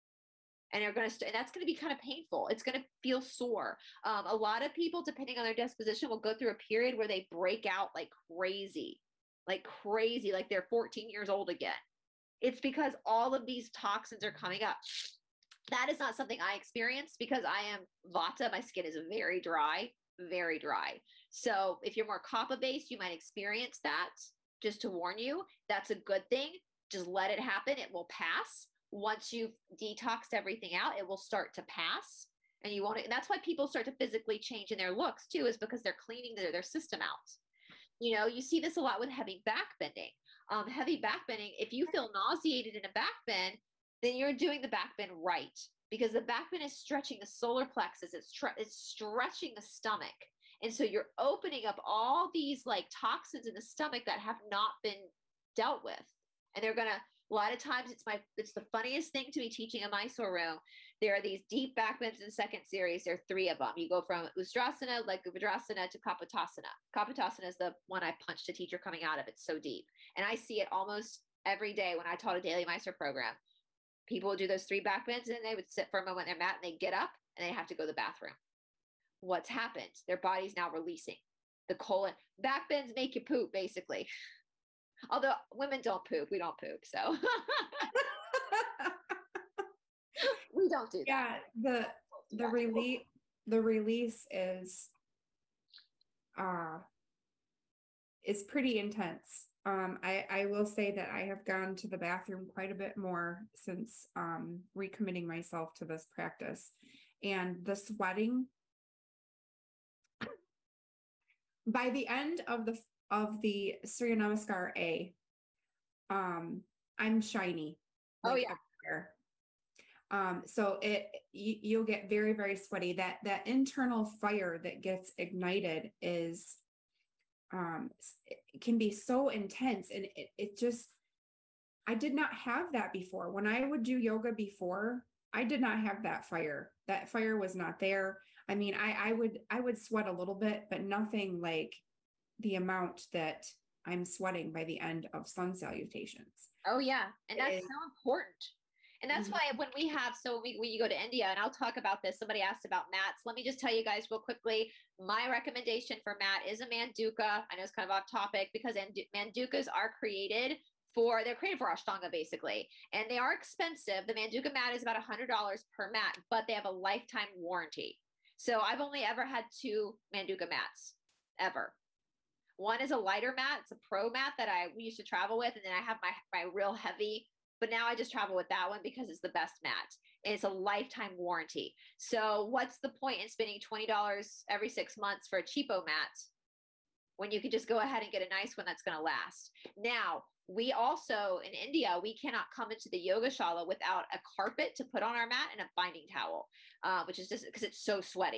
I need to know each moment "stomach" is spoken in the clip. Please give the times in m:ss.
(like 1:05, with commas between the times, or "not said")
0:49, 0:53.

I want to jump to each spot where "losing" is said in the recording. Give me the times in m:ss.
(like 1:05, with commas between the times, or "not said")
not said.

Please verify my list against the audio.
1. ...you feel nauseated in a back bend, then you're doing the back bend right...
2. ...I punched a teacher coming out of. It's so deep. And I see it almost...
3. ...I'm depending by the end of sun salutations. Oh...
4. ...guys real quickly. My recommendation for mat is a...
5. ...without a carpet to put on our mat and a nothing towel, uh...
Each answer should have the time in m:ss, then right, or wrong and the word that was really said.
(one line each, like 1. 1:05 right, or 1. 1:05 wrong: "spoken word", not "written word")
1. 0:41 right
2. 1:08 right
3. 2:23 wrong: "sweating", not "depending"
4. 2:33 right
5. 3:13 wrong: "binding", not "nothing".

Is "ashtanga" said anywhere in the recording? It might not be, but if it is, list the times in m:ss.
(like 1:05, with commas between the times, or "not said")
2:41.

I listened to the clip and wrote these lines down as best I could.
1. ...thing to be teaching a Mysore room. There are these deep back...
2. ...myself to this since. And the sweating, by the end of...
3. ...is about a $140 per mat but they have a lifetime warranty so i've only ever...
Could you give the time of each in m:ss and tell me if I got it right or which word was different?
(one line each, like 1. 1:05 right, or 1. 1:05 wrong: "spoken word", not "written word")
1. 0:59 right
2. 1:45 wrong: "practice", not "since"
3. 2:44 wrong: "100", not "140".